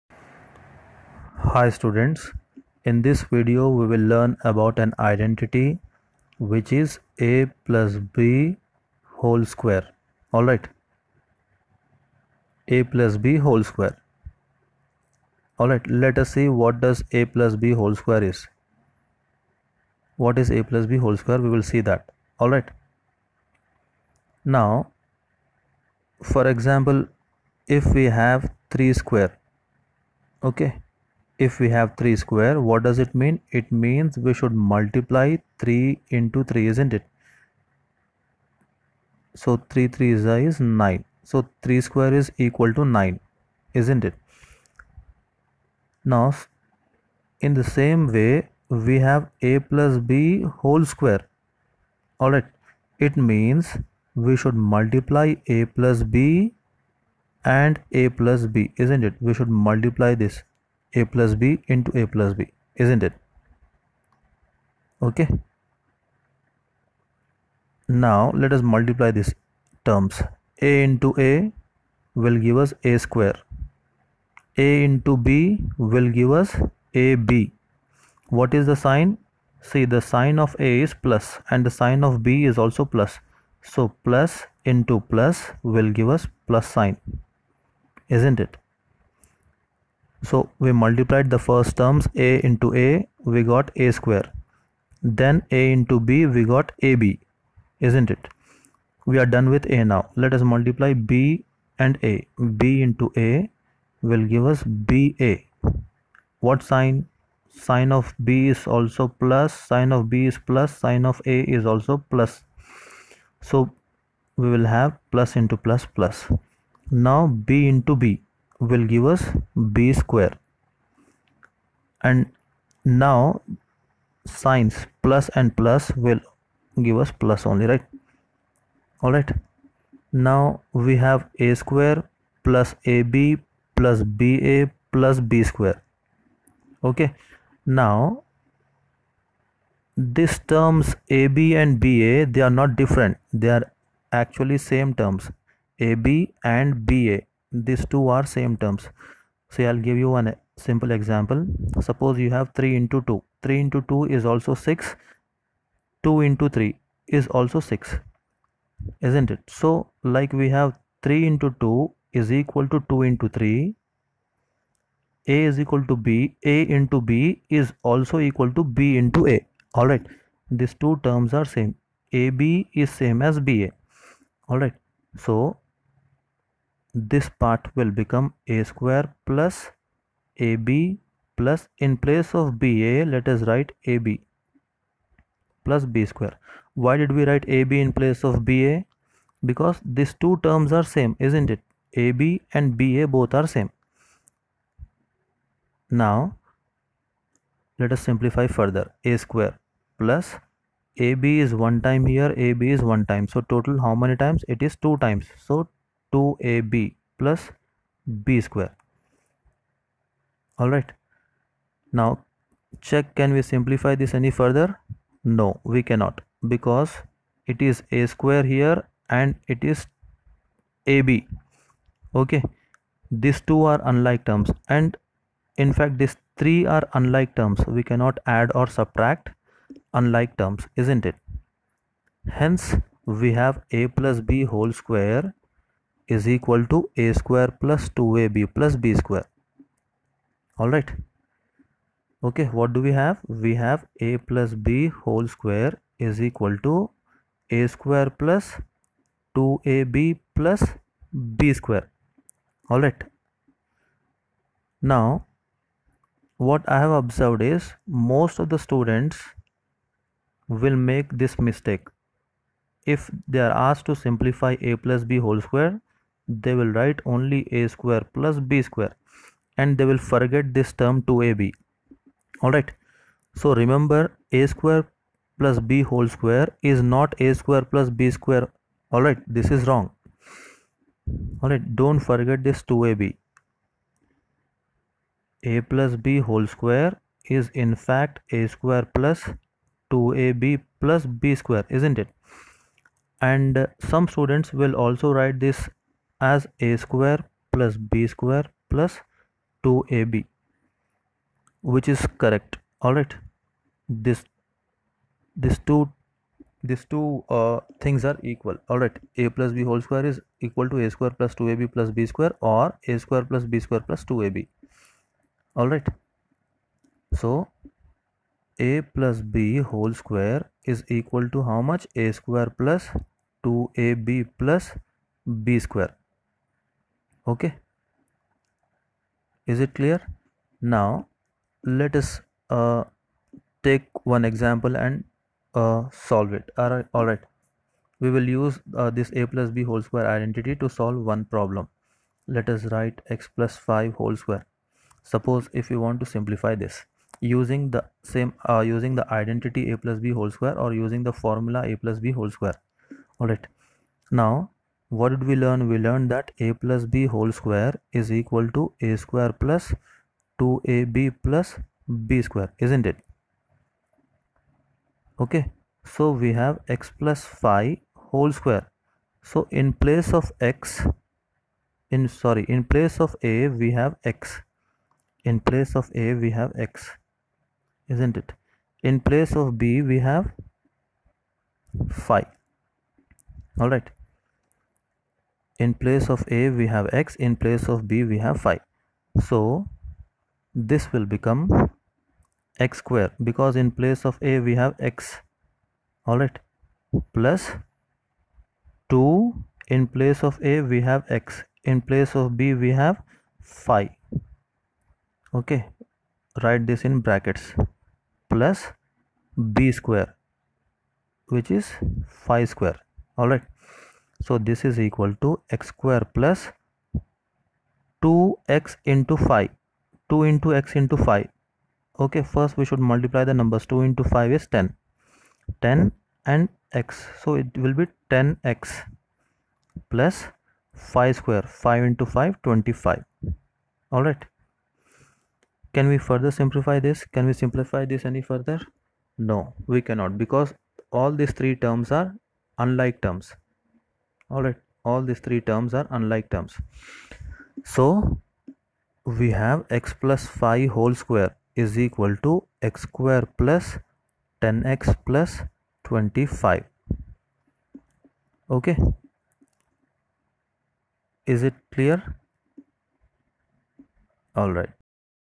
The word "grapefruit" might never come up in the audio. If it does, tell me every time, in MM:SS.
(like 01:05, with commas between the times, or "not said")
not said.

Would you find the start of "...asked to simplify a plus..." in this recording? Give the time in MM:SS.
04:23.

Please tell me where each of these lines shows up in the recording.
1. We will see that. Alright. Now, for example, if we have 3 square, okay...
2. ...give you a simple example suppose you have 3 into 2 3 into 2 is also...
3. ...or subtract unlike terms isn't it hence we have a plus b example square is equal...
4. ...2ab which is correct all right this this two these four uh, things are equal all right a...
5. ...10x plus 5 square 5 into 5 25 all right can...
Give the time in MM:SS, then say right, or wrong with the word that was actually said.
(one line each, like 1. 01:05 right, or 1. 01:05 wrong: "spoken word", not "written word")
1. 00:21 right
2. 02:29 right
3. 03:48 wrong: "whole", not "example"
4. 04:59 wrong: "two", not "four"
5. 07:08 right.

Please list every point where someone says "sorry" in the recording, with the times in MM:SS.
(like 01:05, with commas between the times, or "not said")
06:12.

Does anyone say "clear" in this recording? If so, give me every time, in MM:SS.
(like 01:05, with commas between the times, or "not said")
05:29, 07:41.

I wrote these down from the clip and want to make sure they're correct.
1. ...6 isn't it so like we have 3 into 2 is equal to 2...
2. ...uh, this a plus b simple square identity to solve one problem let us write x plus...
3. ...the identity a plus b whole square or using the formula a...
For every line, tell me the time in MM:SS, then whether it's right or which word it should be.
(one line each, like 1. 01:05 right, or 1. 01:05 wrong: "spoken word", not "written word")
1. 02:37 right
2. 05:38 wrong: "whole", not "simple"
3. 05:48 right.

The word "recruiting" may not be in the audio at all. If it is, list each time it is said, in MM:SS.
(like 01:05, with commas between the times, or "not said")
not said.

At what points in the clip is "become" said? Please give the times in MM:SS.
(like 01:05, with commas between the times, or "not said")
02:57, 06:31.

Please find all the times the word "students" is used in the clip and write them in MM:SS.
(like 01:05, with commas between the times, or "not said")
00:01, 04:18, 04:54.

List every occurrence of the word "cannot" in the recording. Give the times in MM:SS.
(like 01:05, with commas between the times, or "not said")
03:35, 03:47, 07:19.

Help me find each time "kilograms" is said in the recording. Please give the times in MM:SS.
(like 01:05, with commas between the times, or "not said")
not said.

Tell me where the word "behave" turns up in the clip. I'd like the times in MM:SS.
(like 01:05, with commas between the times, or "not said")
not said.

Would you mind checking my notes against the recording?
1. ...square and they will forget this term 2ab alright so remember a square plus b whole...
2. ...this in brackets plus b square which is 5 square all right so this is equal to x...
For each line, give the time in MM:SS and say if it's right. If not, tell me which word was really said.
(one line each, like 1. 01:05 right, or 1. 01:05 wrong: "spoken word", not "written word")
1. 04:28 right
2. 06:46 right.